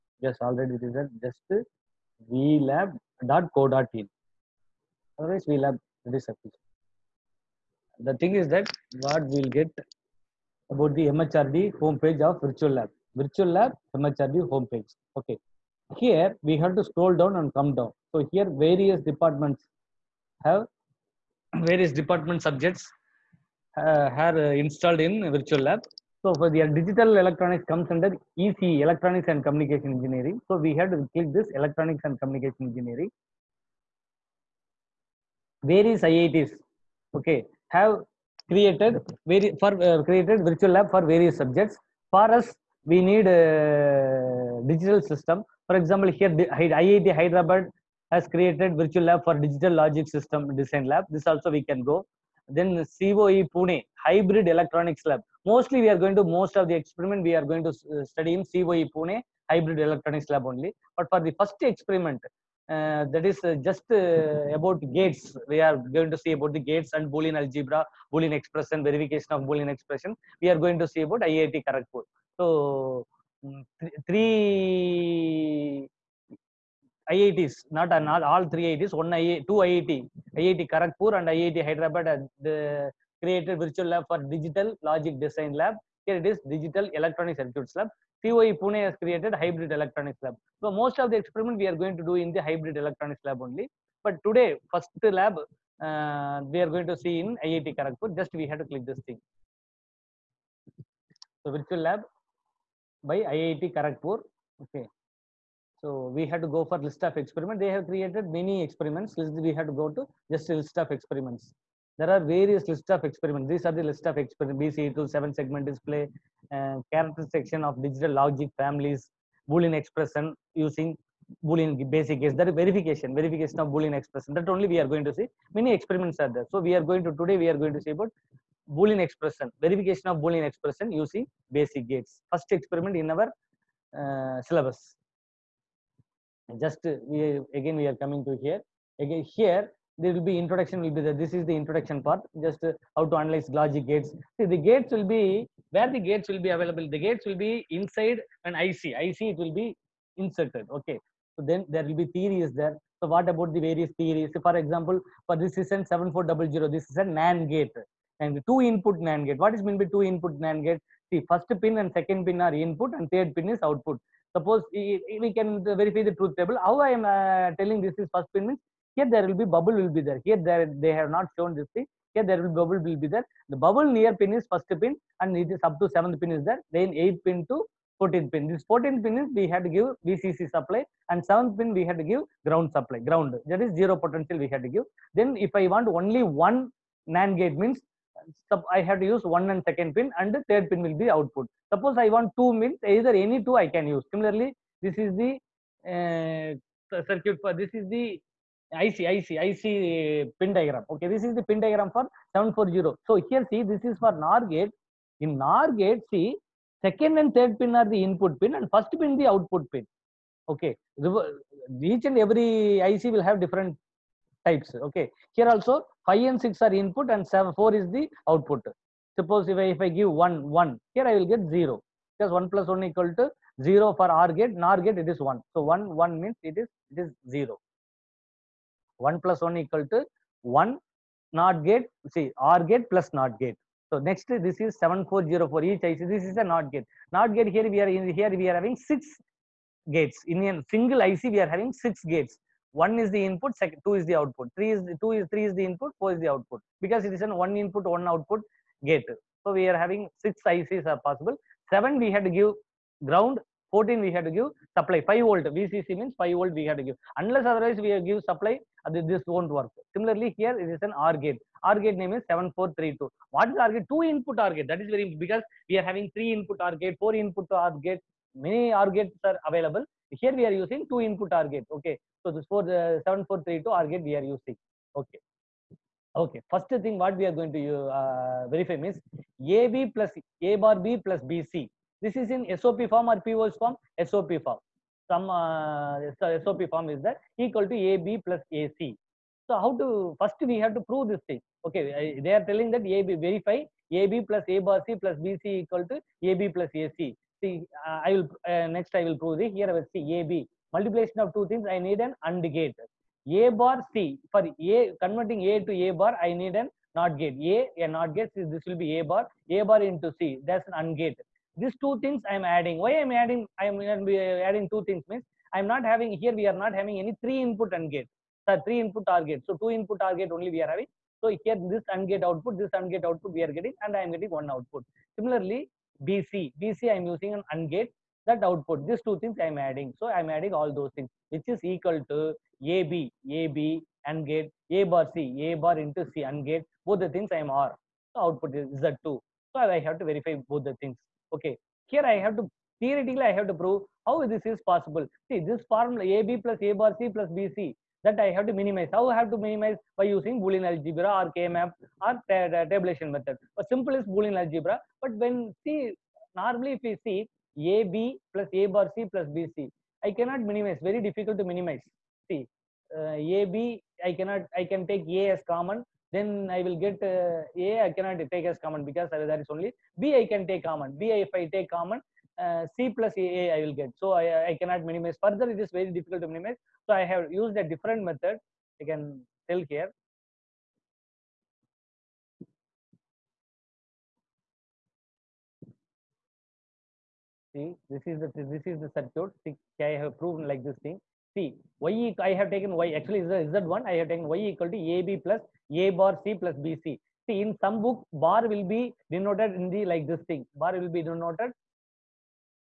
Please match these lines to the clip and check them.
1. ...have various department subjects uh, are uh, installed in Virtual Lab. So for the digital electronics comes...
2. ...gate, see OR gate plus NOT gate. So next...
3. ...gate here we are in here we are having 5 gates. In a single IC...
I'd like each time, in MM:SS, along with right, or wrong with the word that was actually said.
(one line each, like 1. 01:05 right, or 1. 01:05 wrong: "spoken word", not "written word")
1. 00:20 right
2. 03:51 right
3. 03:57 wrong: "6", not "5".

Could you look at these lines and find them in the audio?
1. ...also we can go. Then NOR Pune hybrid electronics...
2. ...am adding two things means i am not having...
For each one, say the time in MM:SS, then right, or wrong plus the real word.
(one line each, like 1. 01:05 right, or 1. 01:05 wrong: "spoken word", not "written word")
1. 00:51 wrong: "COE", not "NOR"
2. 05:13 right.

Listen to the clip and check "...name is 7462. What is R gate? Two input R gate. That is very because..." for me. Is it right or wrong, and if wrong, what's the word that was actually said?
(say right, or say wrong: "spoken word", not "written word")
wrong: "7432", not "7462".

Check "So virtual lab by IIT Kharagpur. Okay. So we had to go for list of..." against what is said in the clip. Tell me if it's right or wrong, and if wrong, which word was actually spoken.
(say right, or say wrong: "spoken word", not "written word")
right.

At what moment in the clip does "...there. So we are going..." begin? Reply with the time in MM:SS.
02:06.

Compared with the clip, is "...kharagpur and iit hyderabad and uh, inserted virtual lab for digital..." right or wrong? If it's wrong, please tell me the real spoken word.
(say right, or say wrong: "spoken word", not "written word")
wrong: "created", not "inserted".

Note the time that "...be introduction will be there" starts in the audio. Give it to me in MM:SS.
02:20.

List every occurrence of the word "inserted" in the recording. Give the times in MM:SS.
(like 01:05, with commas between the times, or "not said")
02:30.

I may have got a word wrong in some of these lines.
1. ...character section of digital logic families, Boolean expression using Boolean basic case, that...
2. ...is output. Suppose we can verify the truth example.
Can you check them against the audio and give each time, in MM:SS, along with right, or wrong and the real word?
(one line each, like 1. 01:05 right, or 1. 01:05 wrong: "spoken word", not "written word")
1. 01:56 right
2. 02:43 wrong: "table", not "example".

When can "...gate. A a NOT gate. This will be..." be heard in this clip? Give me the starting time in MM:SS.
05:07.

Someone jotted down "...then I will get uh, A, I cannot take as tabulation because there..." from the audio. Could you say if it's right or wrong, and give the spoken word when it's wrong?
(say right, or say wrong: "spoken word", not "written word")
wrong: "common", not "tabulation".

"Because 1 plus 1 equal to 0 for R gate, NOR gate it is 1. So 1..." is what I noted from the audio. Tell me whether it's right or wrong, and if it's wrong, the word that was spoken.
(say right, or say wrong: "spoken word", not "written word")
right.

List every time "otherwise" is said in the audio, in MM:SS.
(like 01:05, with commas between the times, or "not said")
00:05, 04:17.